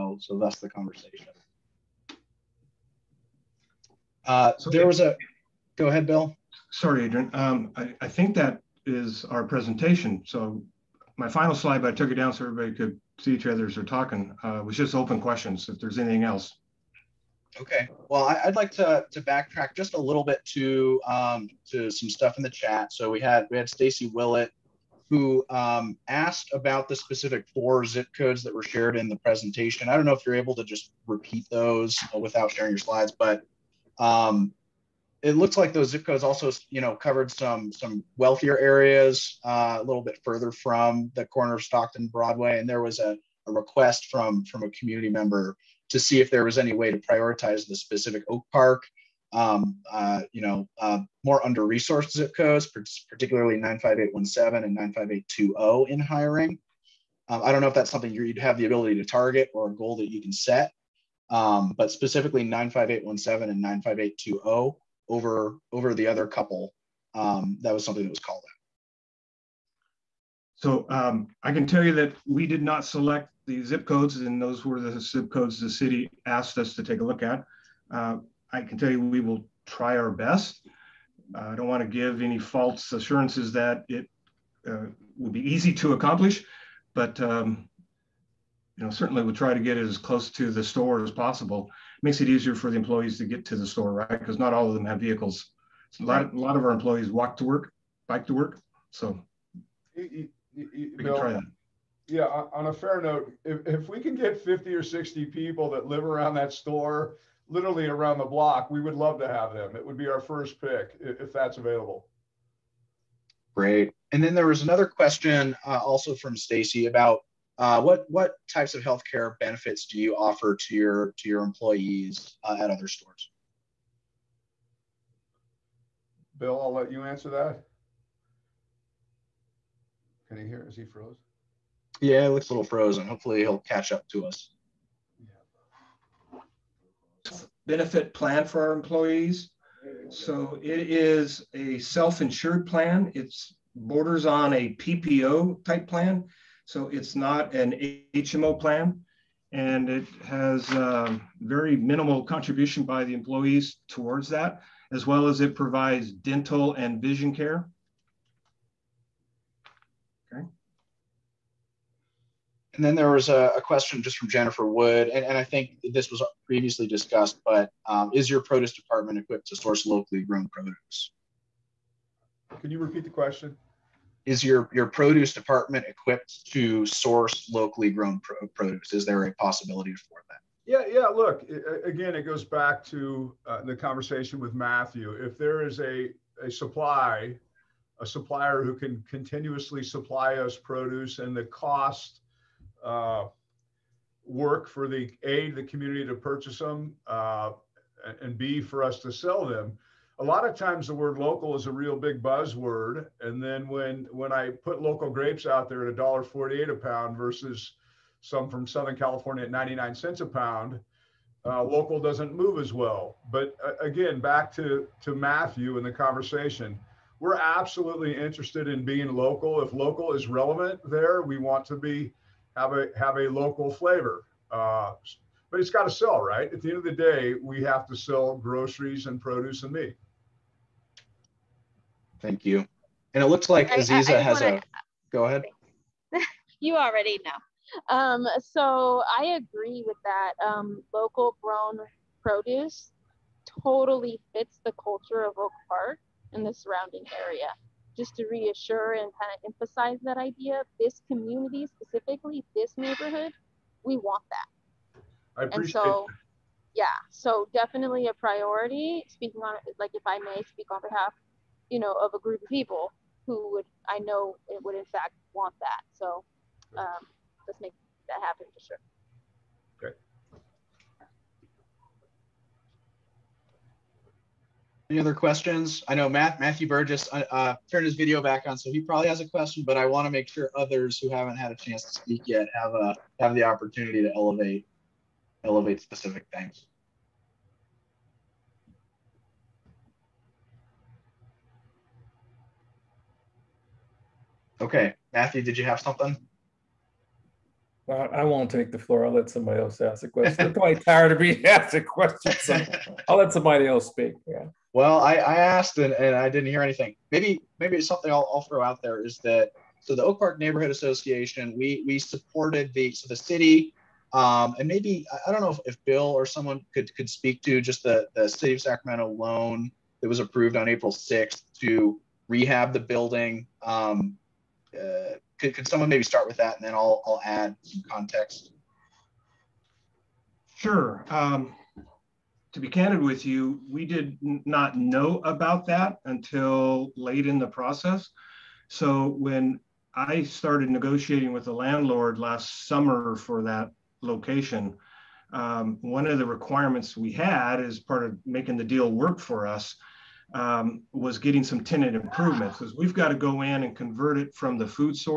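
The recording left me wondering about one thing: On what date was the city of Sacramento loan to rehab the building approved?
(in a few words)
April 6th.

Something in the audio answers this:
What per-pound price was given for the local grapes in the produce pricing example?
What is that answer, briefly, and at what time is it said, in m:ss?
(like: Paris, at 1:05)
$1.48, at 3:25.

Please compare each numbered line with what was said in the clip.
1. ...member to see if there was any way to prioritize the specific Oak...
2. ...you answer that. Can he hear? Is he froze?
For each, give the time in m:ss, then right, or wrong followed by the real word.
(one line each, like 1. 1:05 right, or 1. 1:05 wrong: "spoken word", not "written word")
1. 0:45 right
2. 2:06 right.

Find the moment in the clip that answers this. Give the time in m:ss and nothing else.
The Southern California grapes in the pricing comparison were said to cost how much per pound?
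3:29.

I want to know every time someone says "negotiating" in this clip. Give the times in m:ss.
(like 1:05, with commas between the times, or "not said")
5:40.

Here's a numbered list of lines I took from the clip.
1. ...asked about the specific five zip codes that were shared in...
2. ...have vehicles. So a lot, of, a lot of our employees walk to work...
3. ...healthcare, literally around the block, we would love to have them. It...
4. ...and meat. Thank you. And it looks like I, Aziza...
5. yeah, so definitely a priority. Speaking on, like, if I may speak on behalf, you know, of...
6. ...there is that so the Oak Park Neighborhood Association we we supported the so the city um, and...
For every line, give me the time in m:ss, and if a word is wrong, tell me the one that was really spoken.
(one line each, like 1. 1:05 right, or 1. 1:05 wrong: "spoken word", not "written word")
1. 0:26 wrong: "four", not "five"
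2. 1:34 right
3. 1:46 wrong: "store", not "healthcare"
4. 3:49 right
5. 4:16 right
6. 5:08 right.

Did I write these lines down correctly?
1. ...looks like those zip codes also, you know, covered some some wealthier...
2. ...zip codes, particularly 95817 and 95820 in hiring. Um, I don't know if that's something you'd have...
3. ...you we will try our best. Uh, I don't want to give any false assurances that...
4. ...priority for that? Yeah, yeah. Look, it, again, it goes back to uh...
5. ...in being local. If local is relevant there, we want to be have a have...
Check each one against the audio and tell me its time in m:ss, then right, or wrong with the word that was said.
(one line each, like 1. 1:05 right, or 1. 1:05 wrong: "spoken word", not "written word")
1. 0:35 right
2. 0:52 right
3. 1:18 right
4. 2:59 wrong: "possibility", not "priority"
5. 3:38 right.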